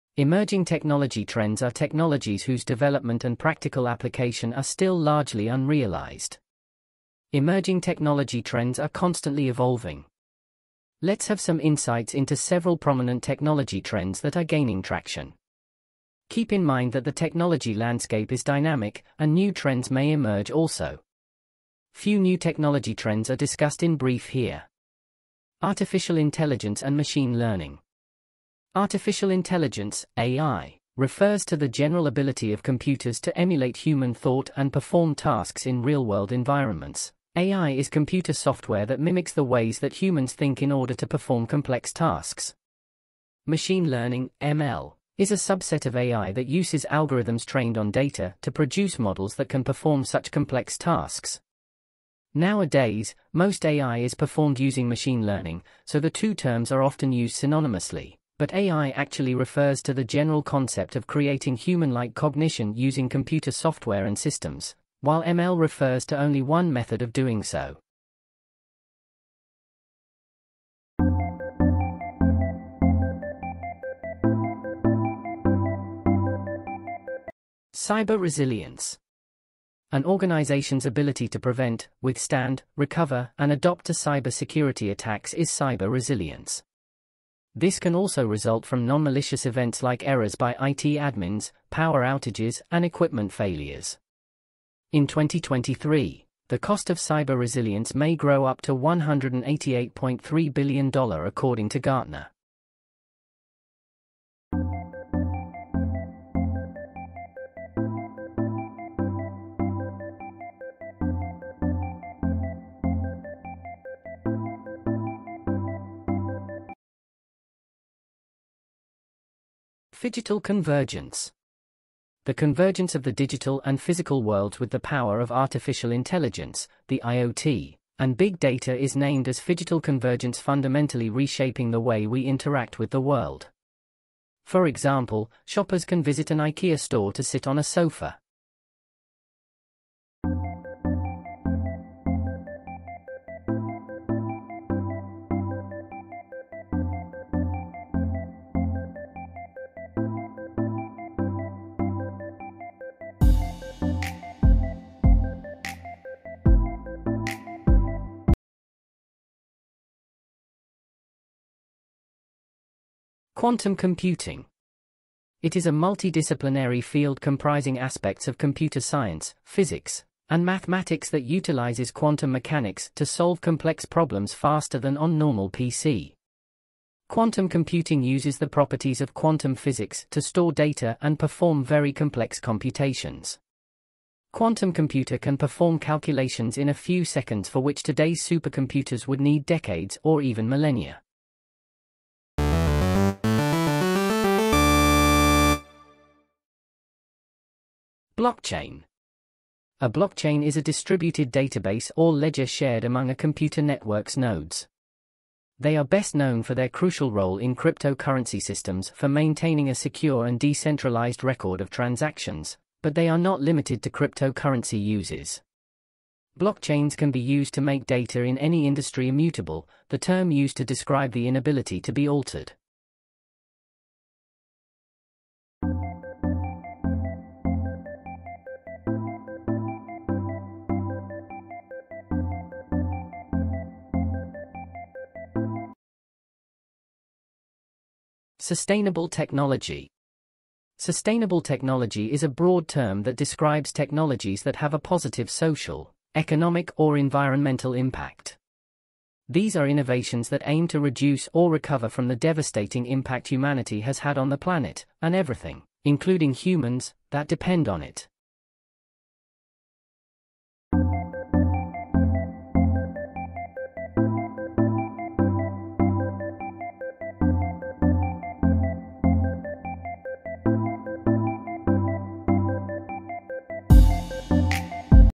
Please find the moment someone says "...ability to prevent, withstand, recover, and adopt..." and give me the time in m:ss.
1:20.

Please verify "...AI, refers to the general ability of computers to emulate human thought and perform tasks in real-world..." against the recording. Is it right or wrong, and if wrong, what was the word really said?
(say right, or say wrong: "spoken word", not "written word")
right.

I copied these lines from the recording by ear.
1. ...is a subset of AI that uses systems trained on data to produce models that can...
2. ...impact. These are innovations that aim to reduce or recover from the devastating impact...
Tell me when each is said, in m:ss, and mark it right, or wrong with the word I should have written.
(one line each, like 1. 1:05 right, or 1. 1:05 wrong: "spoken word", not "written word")
1. 0:45 wrong: "algorithms", not "systems"
2. 4:07 right.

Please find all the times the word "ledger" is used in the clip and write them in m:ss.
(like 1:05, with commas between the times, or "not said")
3:22.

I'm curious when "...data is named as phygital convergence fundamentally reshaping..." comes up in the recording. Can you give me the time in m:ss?
2:08.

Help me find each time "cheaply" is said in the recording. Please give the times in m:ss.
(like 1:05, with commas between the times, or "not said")
not said.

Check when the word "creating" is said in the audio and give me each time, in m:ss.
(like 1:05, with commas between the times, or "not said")
1:01.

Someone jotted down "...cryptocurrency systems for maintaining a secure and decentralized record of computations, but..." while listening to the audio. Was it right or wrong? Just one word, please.
wrong.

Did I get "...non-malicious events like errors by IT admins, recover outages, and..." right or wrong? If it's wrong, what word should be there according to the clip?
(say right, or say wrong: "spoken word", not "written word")
wrong: "power", not "recover".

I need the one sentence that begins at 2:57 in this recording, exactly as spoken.
Quantum computing uses the properties of quantum physics to store data and perform very complex computations.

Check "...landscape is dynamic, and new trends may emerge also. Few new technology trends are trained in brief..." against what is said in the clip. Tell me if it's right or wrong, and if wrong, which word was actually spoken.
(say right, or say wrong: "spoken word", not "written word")
wrong: "discussed", not "trained".